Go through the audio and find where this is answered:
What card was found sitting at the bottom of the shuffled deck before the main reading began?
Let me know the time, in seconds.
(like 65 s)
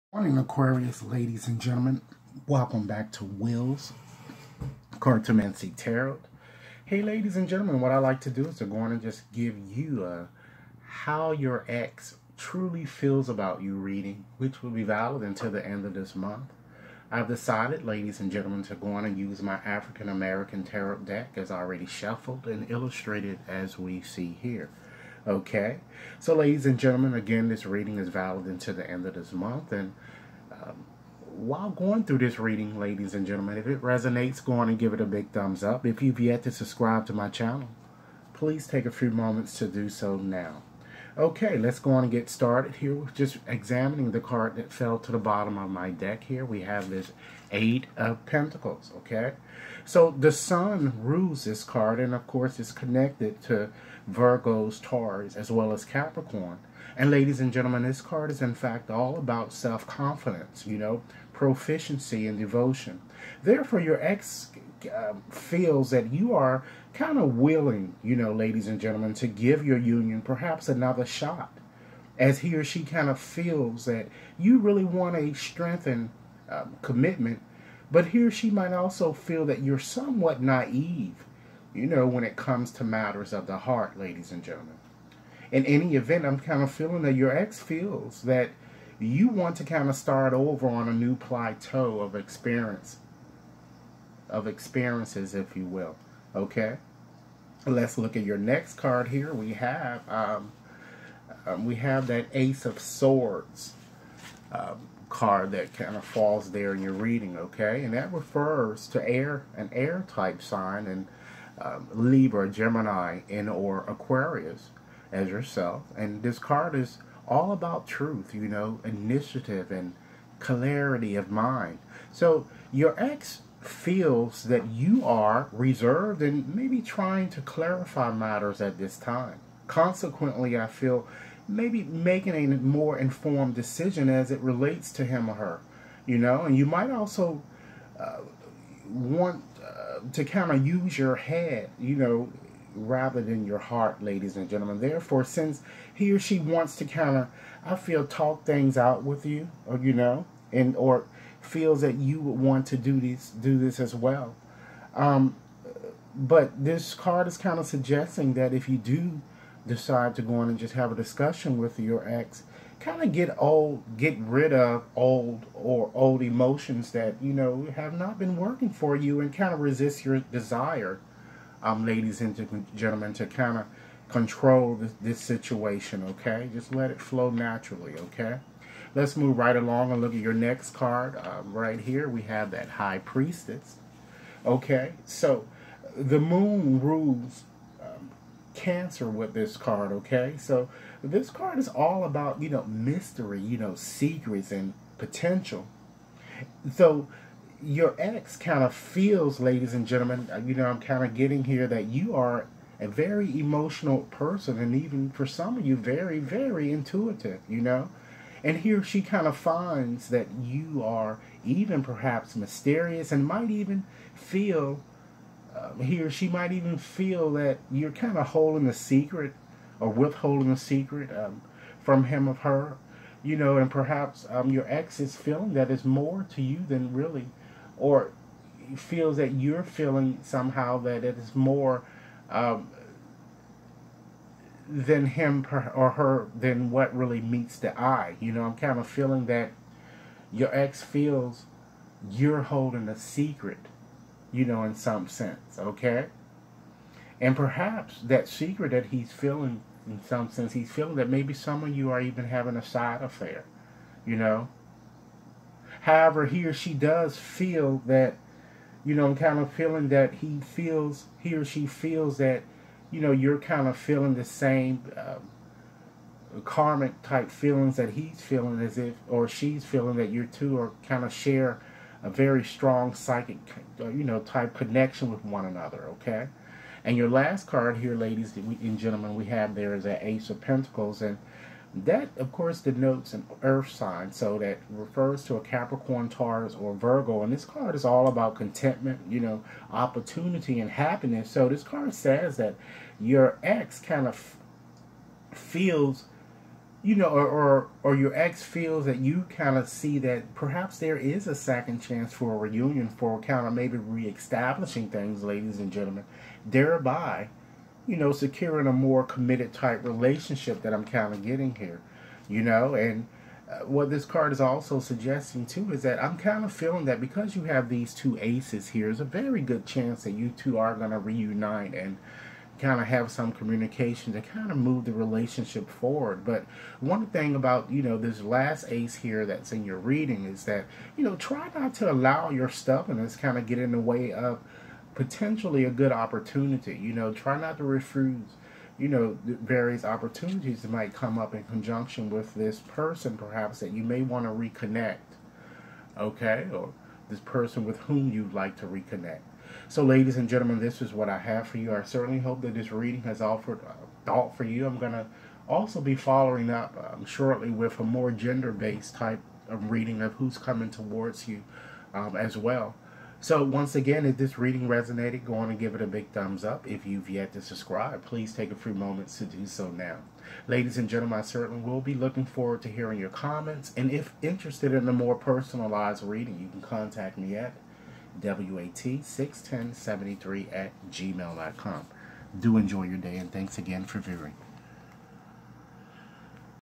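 47 s.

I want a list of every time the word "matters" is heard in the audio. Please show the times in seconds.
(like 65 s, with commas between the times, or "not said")
82 s, 128 s.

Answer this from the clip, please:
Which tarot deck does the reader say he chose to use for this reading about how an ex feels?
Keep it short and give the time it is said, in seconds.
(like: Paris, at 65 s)
African American Tarot deck, at 19 s.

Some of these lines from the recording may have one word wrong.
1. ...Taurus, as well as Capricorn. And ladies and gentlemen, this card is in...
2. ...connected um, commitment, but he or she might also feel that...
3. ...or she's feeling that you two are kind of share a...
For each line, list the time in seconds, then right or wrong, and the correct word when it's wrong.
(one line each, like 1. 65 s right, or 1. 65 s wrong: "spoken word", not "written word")
1. 54 s right
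2. 75 s wrong: "strengthened", not "connected"
3. 269 s right.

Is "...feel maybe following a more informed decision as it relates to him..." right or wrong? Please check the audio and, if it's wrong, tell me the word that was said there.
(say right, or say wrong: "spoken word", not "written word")
wrong: "making", not "following".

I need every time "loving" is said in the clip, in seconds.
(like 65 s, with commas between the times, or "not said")
not said.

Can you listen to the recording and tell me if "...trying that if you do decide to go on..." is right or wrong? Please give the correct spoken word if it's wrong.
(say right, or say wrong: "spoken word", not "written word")
wrong: "suggesting", not "trying".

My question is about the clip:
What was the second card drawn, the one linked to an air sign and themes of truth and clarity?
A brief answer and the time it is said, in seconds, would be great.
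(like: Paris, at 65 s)
Ace of Swords, at 102 s.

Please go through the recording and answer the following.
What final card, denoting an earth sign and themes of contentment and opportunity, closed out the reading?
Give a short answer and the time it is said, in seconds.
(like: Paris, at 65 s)
Ace of Pentacles, at 280 s.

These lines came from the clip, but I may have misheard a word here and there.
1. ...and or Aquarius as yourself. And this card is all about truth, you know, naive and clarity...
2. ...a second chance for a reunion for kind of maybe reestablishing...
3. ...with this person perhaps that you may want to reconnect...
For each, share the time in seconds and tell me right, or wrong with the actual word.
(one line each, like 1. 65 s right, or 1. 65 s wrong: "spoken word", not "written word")
1. 113 s wrong: "initiative", not "naive"
2. 301 s right
3. 342 s right.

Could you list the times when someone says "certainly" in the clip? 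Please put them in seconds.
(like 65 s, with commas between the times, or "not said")
351 s, 371 s.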